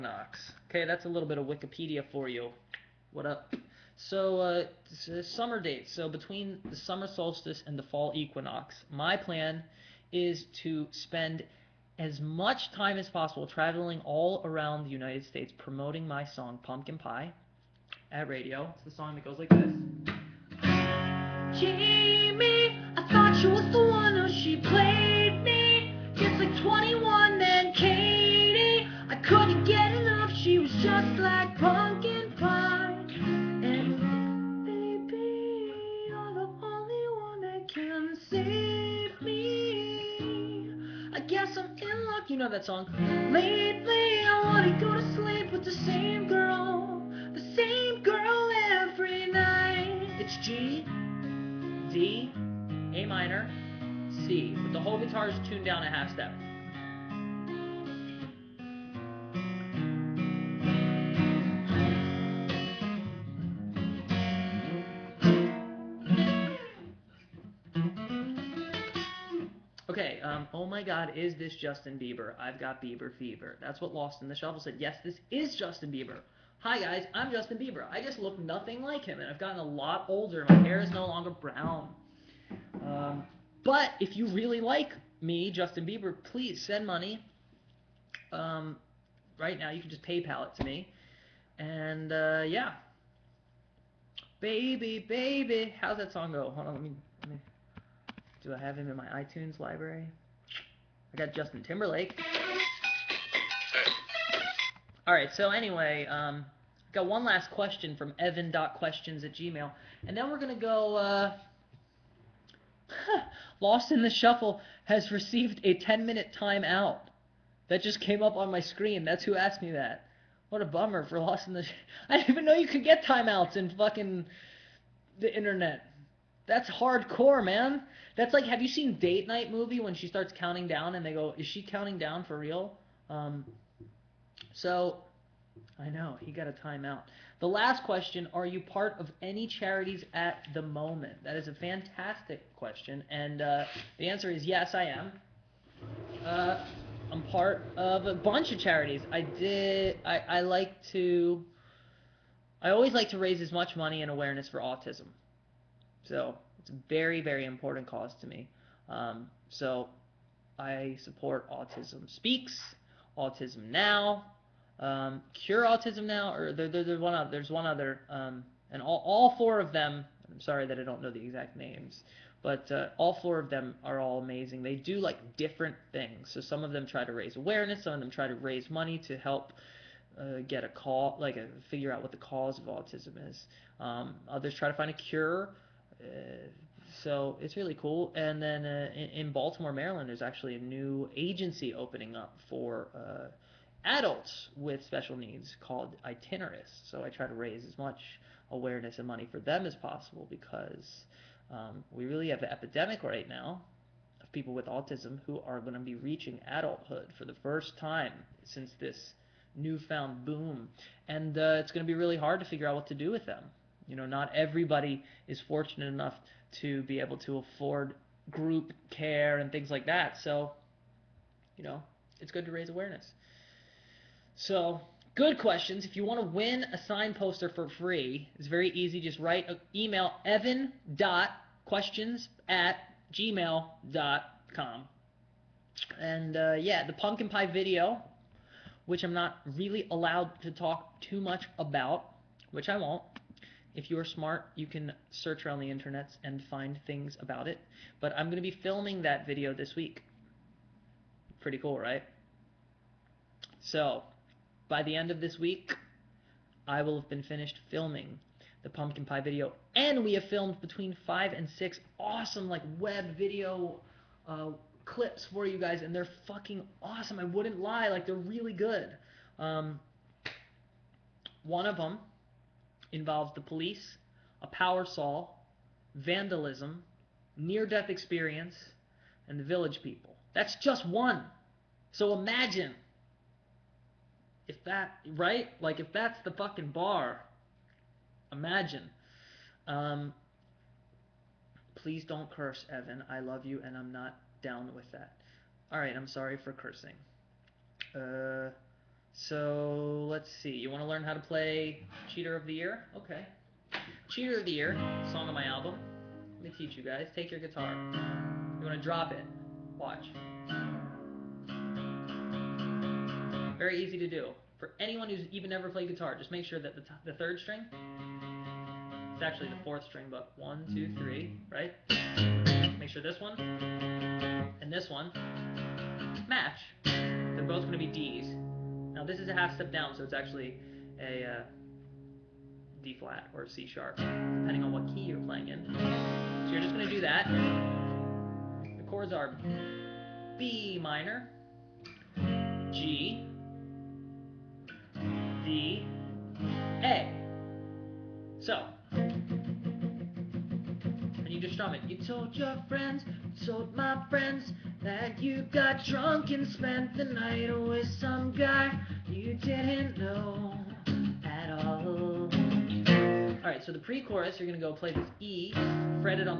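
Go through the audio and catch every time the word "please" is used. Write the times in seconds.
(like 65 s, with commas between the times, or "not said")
86 s, 291 s.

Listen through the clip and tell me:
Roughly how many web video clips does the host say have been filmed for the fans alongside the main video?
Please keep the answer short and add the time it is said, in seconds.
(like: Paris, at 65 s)
5 or 6, at 261 s.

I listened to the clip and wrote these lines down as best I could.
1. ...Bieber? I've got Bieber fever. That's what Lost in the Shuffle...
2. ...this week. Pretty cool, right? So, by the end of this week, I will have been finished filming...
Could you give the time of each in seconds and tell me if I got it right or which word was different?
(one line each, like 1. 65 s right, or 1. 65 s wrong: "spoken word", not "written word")
1. 71 s right
2. 249 s right.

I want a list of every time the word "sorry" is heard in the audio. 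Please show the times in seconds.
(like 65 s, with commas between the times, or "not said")
170 s, 296 s.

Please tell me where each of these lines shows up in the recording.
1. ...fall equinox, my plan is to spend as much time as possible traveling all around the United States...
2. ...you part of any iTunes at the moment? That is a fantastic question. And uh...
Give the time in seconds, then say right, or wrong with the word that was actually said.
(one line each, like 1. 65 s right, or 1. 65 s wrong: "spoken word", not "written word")
1. 7 s right
2. 138 s wrong: "charities", not "iTunes".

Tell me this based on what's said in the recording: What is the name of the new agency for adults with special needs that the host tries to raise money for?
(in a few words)
Itineris.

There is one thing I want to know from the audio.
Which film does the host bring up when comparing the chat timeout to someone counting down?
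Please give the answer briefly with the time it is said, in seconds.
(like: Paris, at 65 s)
Date Night, at 128 s.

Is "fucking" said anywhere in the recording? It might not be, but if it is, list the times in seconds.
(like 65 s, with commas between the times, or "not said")
123 s, 266 s, 286 s.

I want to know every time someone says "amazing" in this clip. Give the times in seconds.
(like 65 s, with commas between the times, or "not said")
174 s.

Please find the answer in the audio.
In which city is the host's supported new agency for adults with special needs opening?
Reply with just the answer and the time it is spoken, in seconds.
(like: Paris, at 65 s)
Baltimore, at 189 s.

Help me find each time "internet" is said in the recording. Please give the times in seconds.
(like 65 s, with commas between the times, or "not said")
125 s, 245 s.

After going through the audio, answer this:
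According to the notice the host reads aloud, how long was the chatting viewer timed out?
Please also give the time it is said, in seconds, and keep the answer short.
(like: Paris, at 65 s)
10 minutes, at 115 s.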